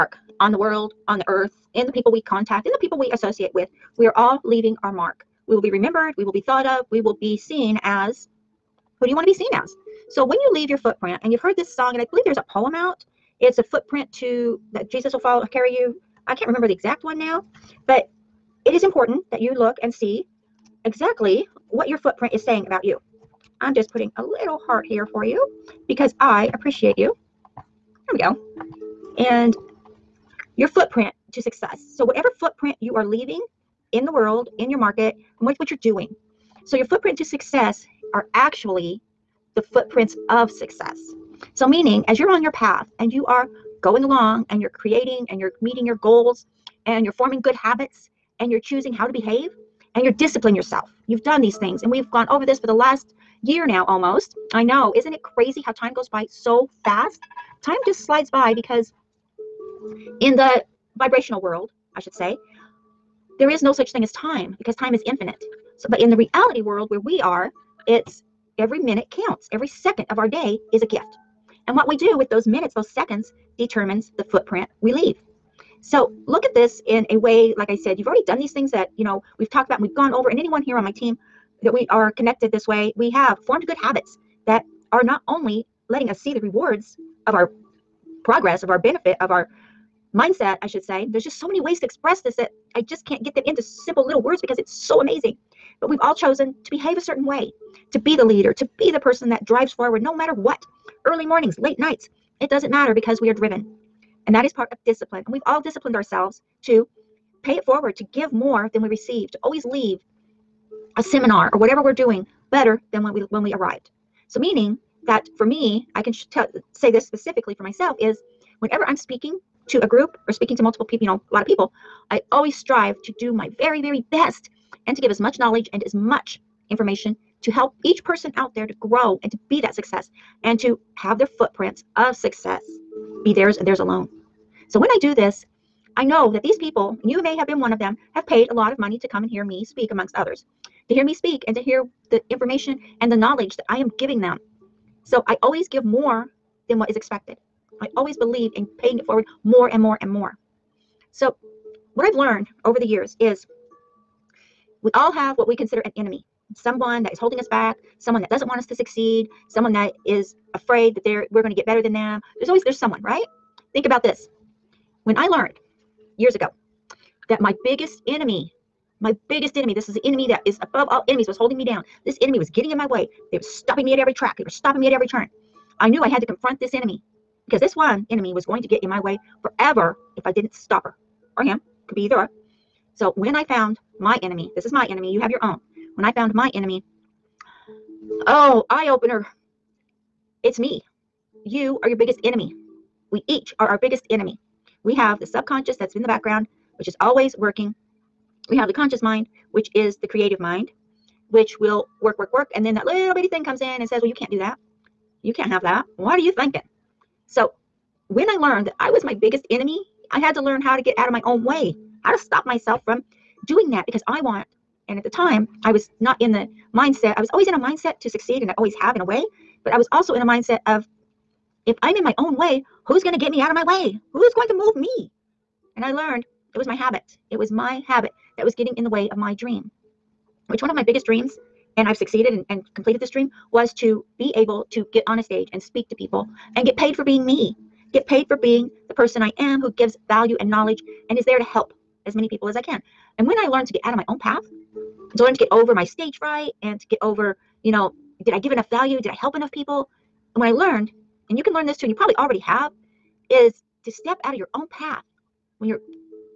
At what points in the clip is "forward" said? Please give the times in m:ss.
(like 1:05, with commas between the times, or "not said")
1:39, 1:47, 2:29.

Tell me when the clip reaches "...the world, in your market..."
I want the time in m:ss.
0:34.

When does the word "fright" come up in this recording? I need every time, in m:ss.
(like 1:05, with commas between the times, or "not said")
4:06.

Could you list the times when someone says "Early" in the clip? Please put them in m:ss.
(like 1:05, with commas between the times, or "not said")
1:41.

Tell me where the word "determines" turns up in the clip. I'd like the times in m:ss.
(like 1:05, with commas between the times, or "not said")
1:13.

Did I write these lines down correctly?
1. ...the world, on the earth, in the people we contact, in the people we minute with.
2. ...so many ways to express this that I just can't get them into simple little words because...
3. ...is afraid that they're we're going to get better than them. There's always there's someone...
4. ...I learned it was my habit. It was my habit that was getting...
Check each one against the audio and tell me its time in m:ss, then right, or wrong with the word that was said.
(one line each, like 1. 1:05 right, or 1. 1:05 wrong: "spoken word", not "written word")
1. 0:00 wrong: "associate", not "minute"
2. 1:31 right
3. 2:40 right
4. 3:45 right.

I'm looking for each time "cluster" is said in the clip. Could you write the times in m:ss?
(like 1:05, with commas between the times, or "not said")
not said.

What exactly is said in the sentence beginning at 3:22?
And then that little bitty thing comes in and says, Well, you can't do that.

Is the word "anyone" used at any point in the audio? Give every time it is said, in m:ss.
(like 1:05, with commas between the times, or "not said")
1:20.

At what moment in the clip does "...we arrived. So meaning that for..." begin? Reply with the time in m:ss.
1:53.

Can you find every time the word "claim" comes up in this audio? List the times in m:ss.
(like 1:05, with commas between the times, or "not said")
not said.